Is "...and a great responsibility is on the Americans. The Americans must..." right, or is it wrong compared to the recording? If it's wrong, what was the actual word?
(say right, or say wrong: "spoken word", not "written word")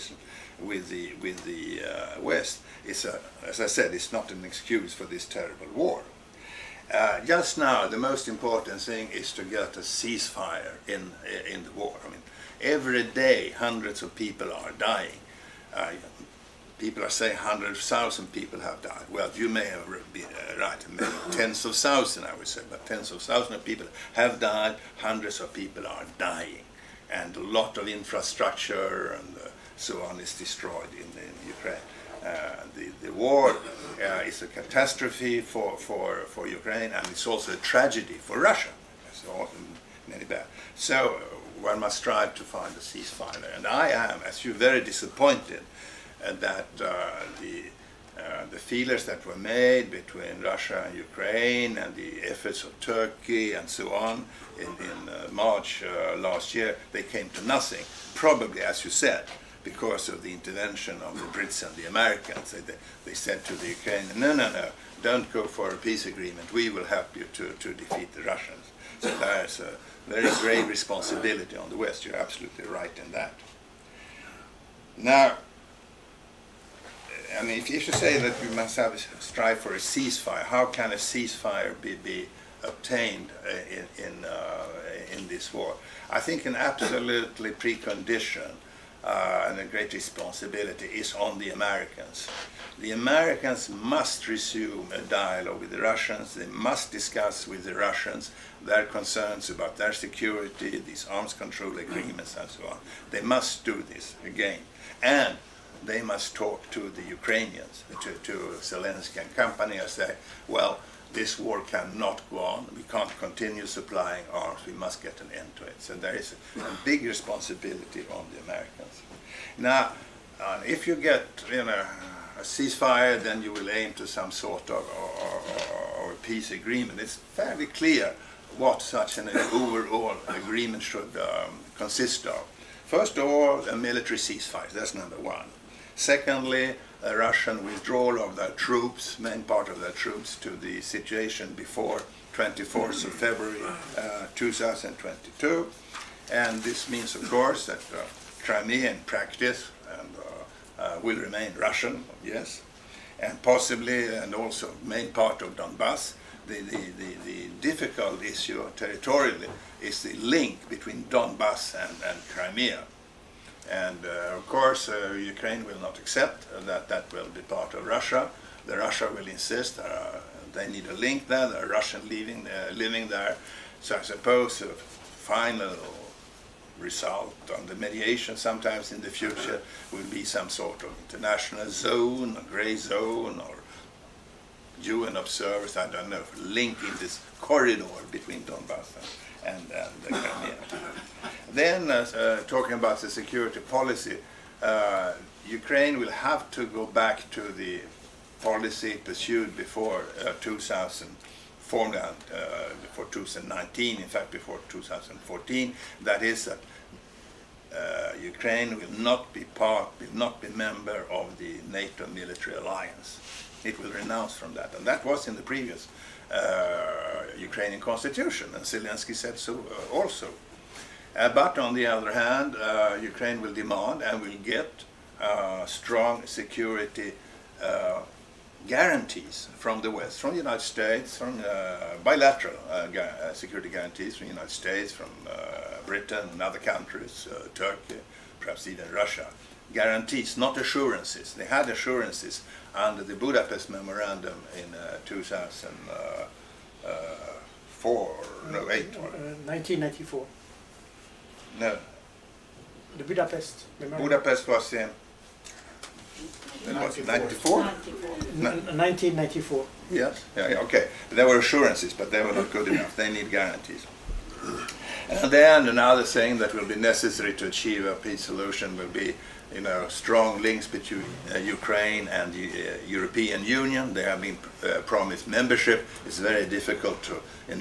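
right.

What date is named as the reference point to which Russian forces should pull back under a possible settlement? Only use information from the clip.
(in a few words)
24th of February 2022.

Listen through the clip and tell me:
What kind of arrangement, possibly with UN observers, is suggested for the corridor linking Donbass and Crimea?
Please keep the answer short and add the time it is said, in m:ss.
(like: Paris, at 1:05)
grey zone, at 3:02.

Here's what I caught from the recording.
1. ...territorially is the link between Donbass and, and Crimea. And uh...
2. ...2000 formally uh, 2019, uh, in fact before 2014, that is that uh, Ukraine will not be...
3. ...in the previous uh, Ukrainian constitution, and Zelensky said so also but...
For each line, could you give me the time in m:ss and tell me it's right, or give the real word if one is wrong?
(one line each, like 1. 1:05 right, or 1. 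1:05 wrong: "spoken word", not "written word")
1. 2:38 right
2. 3:20 right
3. 3:35 right.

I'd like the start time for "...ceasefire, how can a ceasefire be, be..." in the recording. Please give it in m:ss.
1:19.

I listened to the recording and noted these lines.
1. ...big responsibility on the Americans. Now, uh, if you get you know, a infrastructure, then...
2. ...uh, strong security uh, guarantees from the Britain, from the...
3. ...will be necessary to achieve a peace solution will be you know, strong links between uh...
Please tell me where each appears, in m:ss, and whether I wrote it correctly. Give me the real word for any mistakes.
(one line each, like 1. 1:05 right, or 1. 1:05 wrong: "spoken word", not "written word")
1. 1:56 wrong: "ceasefire", not "infrastructure"
2. 3:45 wrong: "West", not "Britain"
3. 4:26 right.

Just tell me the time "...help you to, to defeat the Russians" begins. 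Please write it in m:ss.
1:06.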